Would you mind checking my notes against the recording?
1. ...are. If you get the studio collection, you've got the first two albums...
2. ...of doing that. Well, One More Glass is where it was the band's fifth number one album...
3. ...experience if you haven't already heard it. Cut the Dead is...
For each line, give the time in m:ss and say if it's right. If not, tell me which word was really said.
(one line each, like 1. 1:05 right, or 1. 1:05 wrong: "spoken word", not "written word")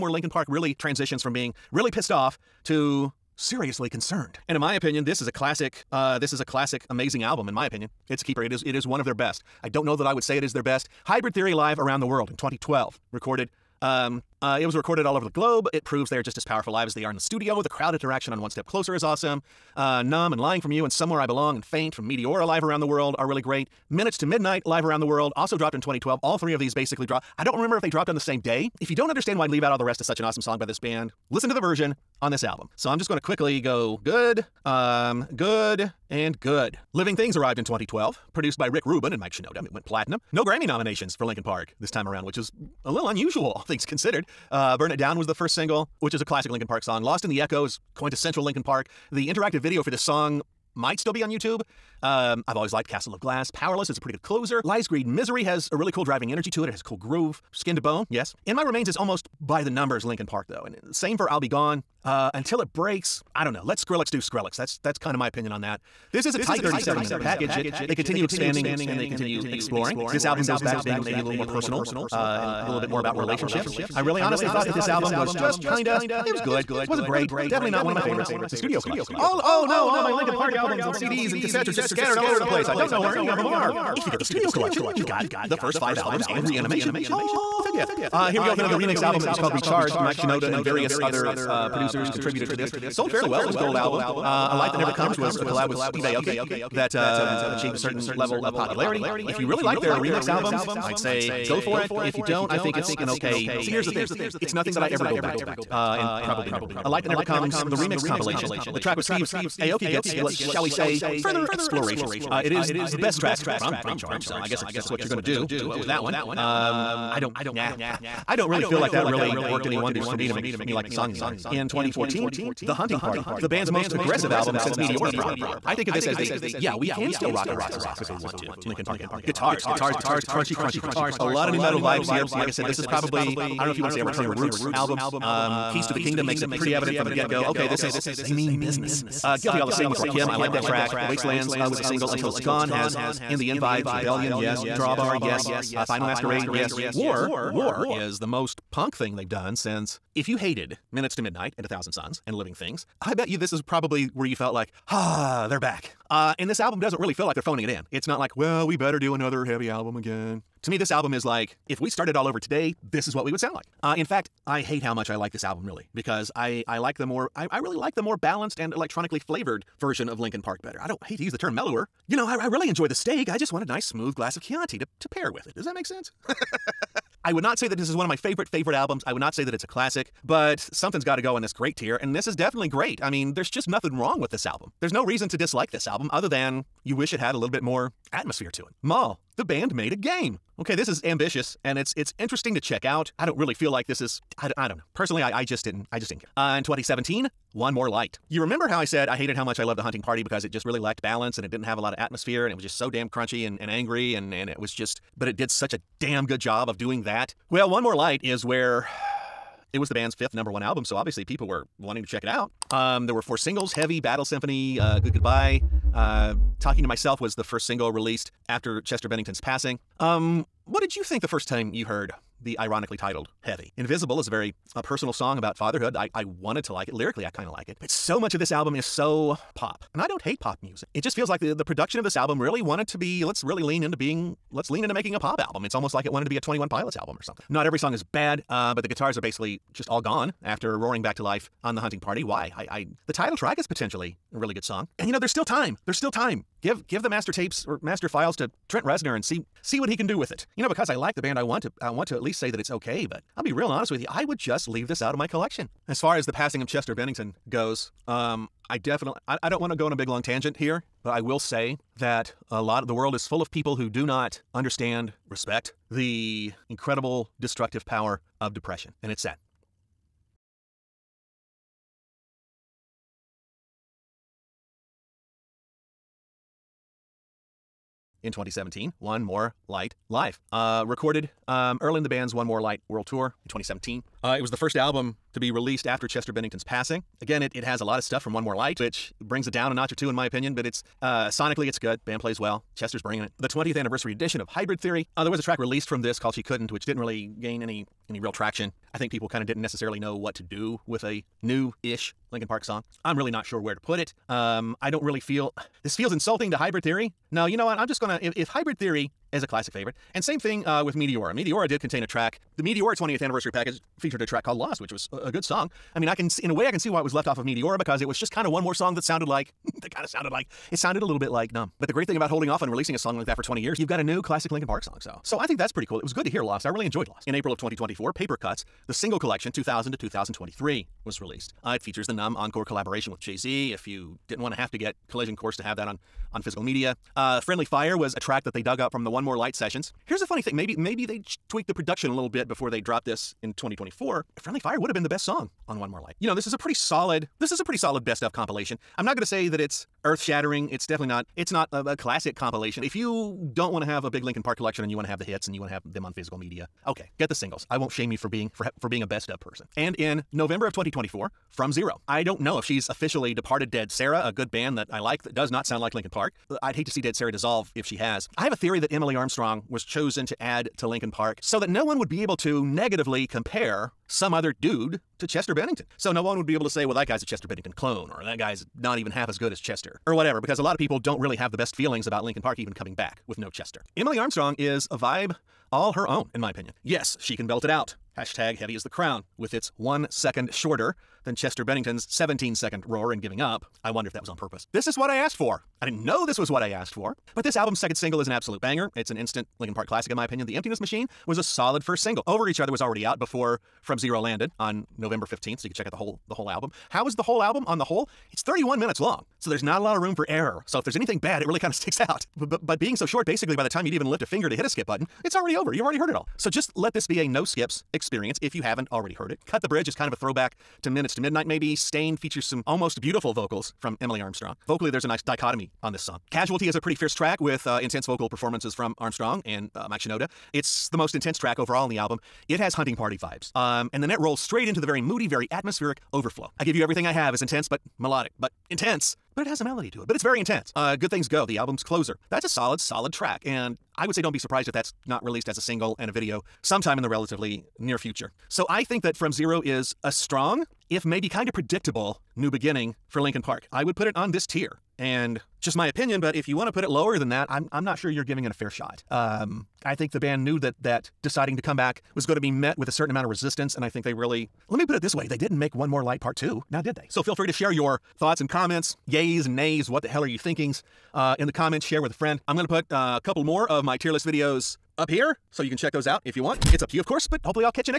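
1. 1:23 wrong: "five", not "two"
2. 3:26 wrong: "Light", not "Glass"
3. 6:57 wrong: "Bridge", not "Dead".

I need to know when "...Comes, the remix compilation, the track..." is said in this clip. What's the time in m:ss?
1:47.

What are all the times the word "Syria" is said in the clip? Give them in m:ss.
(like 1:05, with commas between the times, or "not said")
not said.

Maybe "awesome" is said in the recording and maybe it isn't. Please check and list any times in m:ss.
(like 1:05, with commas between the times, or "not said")
0:19, 0:30.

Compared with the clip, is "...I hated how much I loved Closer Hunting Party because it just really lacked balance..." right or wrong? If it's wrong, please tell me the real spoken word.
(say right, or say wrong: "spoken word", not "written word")
wrong: "The", not "Closer".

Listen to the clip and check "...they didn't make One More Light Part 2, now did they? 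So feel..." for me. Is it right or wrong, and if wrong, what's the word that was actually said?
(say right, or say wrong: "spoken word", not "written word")
right.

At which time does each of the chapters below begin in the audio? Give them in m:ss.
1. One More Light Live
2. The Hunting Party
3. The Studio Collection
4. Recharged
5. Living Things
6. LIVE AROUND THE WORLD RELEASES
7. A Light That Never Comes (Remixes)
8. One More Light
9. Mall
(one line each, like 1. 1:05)
1. 4:37
2. 2:01
3. 1:17
4. 1:28
5. 0:36
6. 0:10
7. 1:46
8. 3:16
9. 3:08.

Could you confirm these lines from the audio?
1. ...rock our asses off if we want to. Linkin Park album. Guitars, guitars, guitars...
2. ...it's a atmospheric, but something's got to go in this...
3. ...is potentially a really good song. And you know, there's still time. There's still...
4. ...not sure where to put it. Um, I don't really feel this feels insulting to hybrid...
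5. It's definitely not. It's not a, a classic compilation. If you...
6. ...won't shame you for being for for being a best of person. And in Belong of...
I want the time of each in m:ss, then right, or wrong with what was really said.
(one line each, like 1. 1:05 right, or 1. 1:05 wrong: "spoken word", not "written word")
1. 2:07 right
2. 2:59 wrong: "classic", not "atmospheric"
3. 4:03 right
4. 5:03 right
5. 5:50 right
6. 5:57 wrong: "November", not "Belong".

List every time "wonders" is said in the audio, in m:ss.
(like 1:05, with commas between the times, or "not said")
1:59, 6:33.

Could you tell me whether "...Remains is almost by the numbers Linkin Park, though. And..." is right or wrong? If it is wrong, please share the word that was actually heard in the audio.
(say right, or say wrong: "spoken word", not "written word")
right.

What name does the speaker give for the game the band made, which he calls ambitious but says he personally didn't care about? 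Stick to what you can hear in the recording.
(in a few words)
Maul.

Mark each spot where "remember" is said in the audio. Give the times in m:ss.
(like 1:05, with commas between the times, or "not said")
0:27, 3:18.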